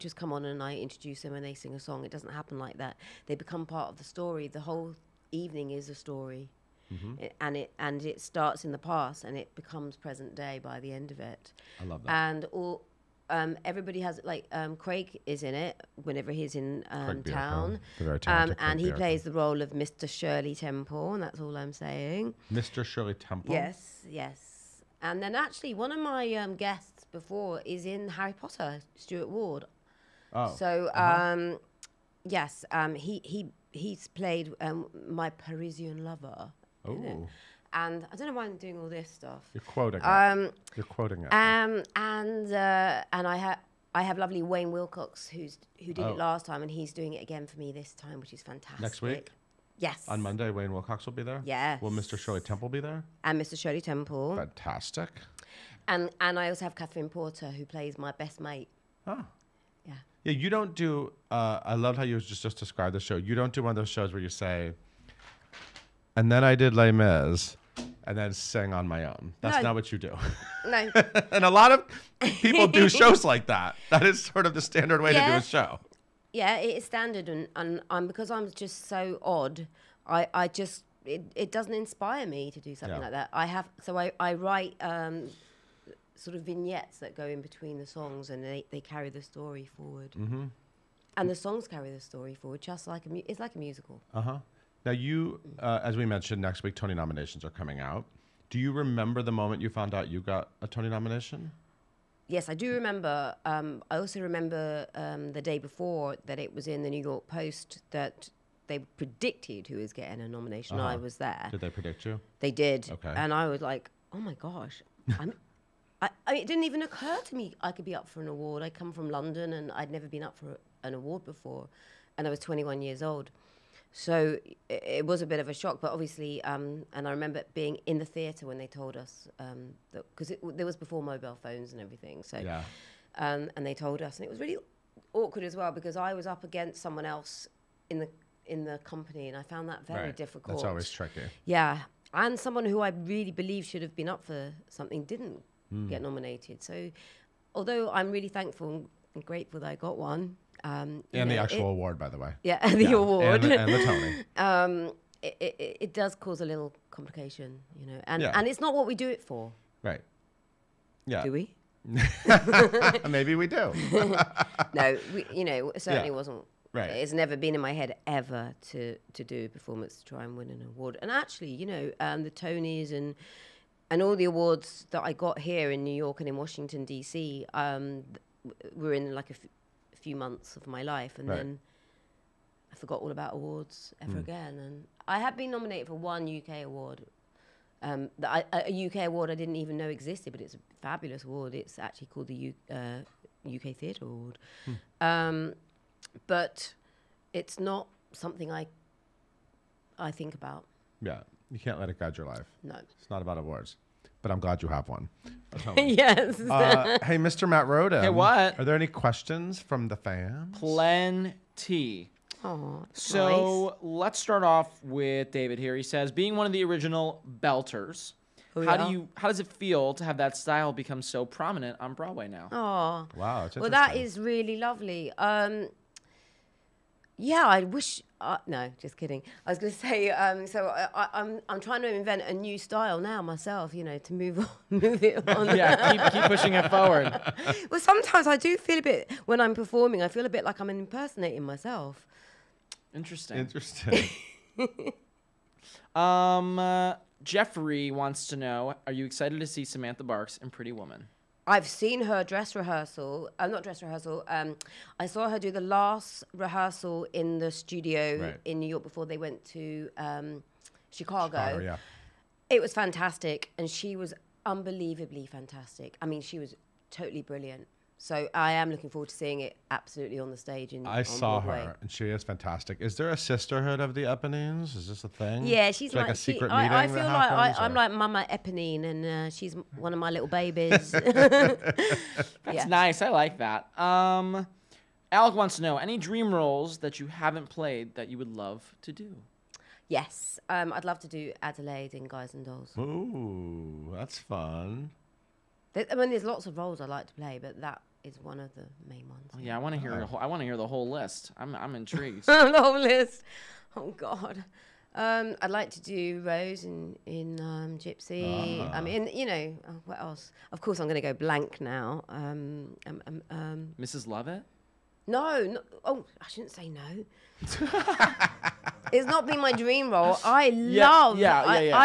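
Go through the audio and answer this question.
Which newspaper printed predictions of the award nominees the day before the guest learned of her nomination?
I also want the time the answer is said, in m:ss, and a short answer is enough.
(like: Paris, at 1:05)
New York Post, at 1:46.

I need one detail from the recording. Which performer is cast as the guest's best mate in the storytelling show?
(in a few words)
Catherine Porter.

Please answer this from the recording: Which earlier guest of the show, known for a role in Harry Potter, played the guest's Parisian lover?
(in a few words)
Stuart Ward.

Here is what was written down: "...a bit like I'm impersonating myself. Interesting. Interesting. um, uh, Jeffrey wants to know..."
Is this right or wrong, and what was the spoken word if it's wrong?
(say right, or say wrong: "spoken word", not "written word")
right.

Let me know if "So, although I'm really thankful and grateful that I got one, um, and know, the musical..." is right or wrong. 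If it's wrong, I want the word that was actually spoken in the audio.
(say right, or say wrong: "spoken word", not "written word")
wrong: "actual", not "musical".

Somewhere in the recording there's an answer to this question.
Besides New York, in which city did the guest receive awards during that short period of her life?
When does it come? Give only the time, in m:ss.
2:56.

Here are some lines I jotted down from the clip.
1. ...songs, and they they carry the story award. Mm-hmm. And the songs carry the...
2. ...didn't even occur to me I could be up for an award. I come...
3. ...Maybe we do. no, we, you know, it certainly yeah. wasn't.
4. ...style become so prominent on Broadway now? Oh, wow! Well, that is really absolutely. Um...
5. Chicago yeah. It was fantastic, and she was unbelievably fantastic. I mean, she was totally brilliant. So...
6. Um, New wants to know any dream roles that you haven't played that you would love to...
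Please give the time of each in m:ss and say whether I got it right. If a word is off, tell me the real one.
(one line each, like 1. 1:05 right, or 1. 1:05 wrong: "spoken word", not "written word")
1. 1:27 wrong: "forward", not "award"
2. 1:56 right
3. 2:43 right
4. 3:40 wrong: "lovely", not "absolutely"
5. 4:21 right
6. 4:43 wrong: "Alec", not "New".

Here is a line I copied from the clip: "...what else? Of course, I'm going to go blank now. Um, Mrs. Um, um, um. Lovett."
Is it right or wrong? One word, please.
right.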